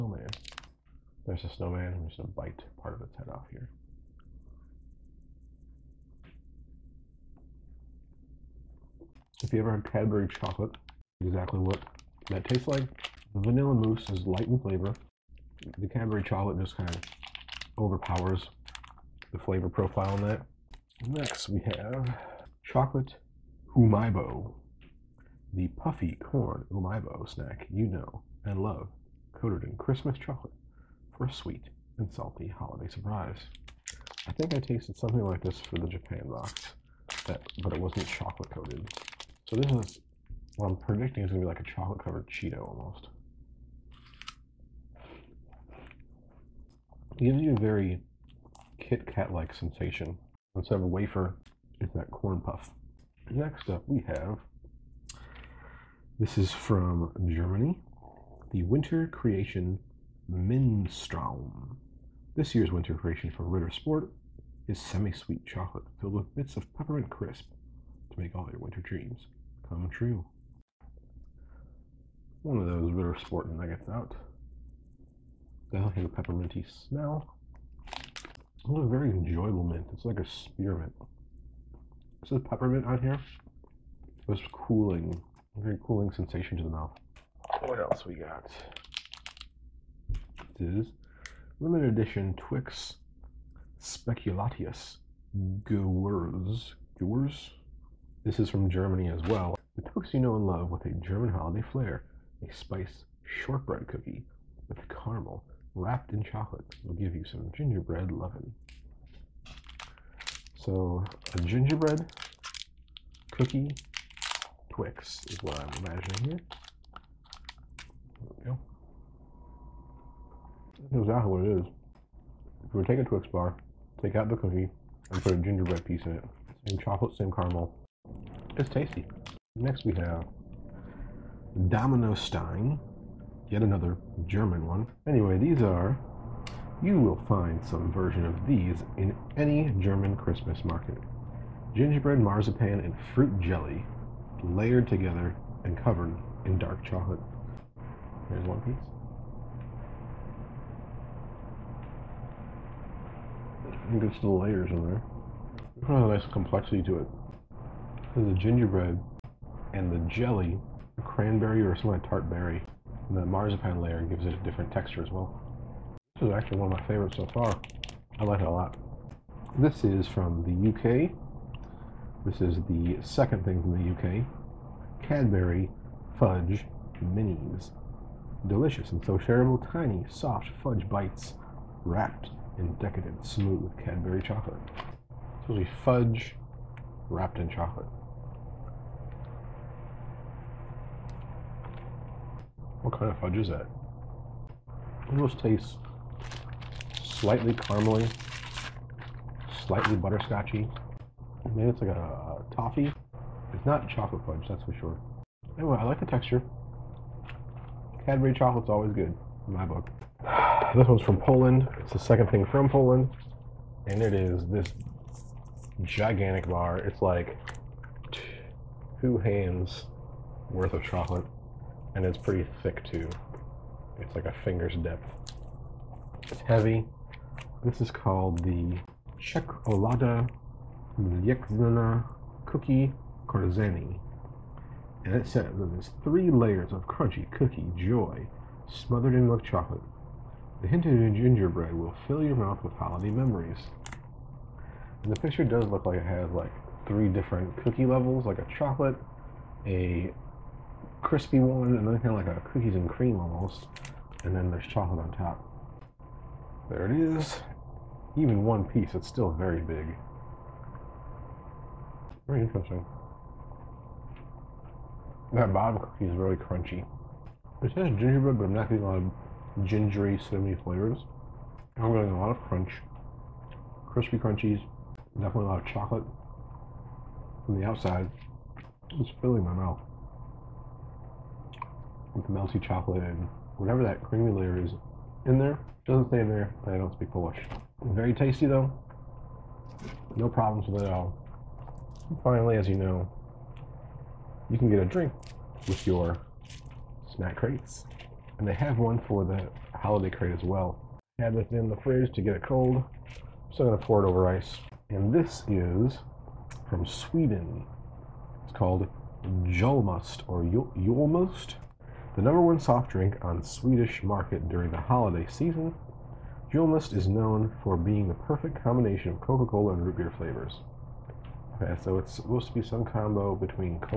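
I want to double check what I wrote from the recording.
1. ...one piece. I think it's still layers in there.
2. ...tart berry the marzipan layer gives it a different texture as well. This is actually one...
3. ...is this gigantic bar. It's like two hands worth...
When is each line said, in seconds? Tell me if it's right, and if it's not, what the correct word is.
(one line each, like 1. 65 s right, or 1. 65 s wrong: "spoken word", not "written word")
1. 148 s right
2. 162 s right
3. 214 s right.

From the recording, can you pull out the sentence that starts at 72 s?
One of those Ritter Sport nuggets out.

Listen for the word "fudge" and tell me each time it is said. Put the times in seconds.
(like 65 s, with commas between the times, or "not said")
176 s, 180 s, 185 s, 193 s, 204 s.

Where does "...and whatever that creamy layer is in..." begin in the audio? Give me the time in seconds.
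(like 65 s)
283 s.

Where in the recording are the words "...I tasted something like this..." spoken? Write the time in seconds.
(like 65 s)
34 s.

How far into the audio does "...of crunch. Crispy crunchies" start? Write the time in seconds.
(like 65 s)
272 s.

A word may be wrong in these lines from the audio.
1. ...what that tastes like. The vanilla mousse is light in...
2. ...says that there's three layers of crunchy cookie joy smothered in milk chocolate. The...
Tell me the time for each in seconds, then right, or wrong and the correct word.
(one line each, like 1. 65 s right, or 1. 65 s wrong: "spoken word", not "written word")
1. 11 s right
2. 235 s right.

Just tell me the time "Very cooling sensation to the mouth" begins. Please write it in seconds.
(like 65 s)
85 s.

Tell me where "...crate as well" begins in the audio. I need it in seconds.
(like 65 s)
300 s.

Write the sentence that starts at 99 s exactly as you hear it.
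The Twix you know and love with a German holiday flair, a spice shortbread cookie with caramel, wrapped in chocolate.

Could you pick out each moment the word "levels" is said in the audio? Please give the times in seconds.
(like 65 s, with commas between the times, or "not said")
247 s.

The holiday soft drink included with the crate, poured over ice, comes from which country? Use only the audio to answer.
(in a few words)
Sweden.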